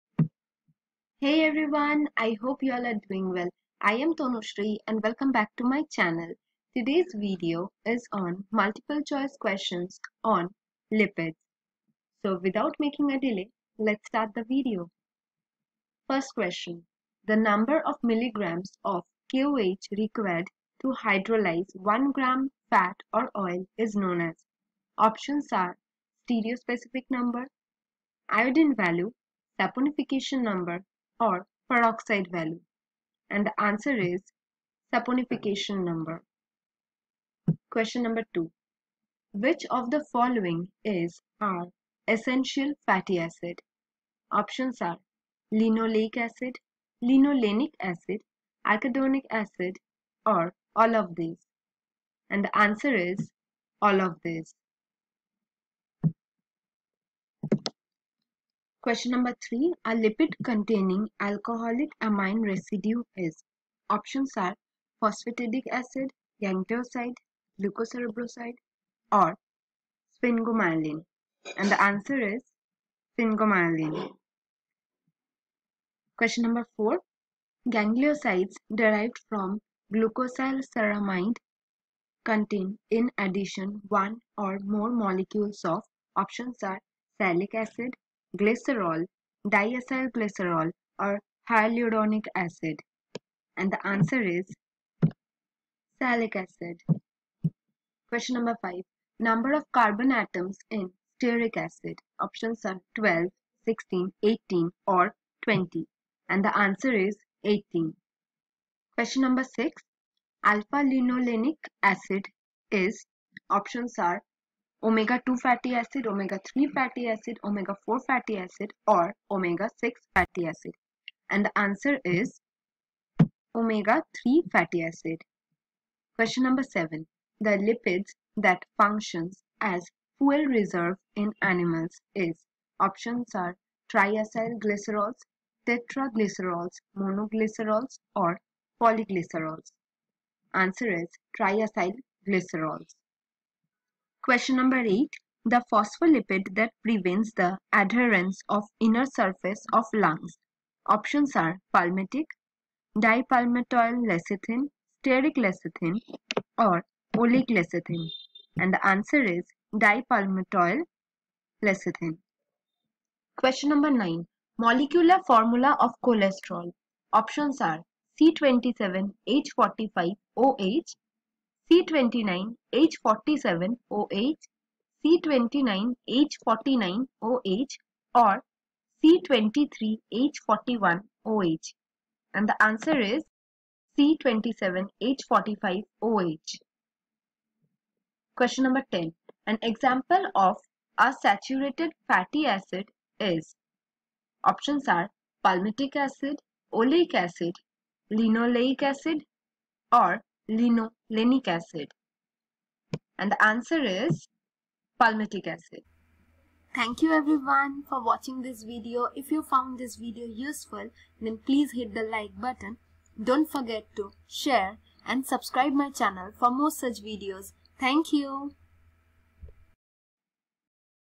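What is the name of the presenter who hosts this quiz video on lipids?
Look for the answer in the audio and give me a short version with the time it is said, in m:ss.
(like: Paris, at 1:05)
Tanushree, at 0:04.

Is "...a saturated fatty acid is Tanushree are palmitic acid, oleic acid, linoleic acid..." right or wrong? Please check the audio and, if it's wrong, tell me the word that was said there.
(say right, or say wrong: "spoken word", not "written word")
wrong: "Options", not "Tanushree".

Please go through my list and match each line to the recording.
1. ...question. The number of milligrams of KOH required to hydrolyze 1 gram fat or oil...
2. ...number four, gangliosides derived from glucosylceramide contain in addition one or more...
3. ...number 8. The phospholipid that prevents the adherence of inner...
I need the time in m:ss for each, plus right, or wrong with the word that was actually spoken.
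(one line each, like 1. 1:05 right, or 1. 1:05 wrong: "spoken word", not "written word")
1. 0:16 right
2. 1:16 right
3. 2:24 right.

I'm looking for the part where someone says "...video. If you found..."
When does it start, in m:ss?
3:28.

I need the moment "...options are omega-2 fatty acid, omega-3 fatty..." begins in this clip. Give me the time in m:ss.
1:53.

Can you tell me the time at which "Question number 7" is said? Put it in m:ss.
2:06.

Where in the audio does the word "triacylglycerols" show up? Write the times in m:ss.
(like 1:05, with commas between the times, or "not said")
2:13, 2:21.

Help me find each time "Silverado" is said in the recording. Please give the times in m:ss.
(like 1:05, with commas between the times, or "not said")
not said.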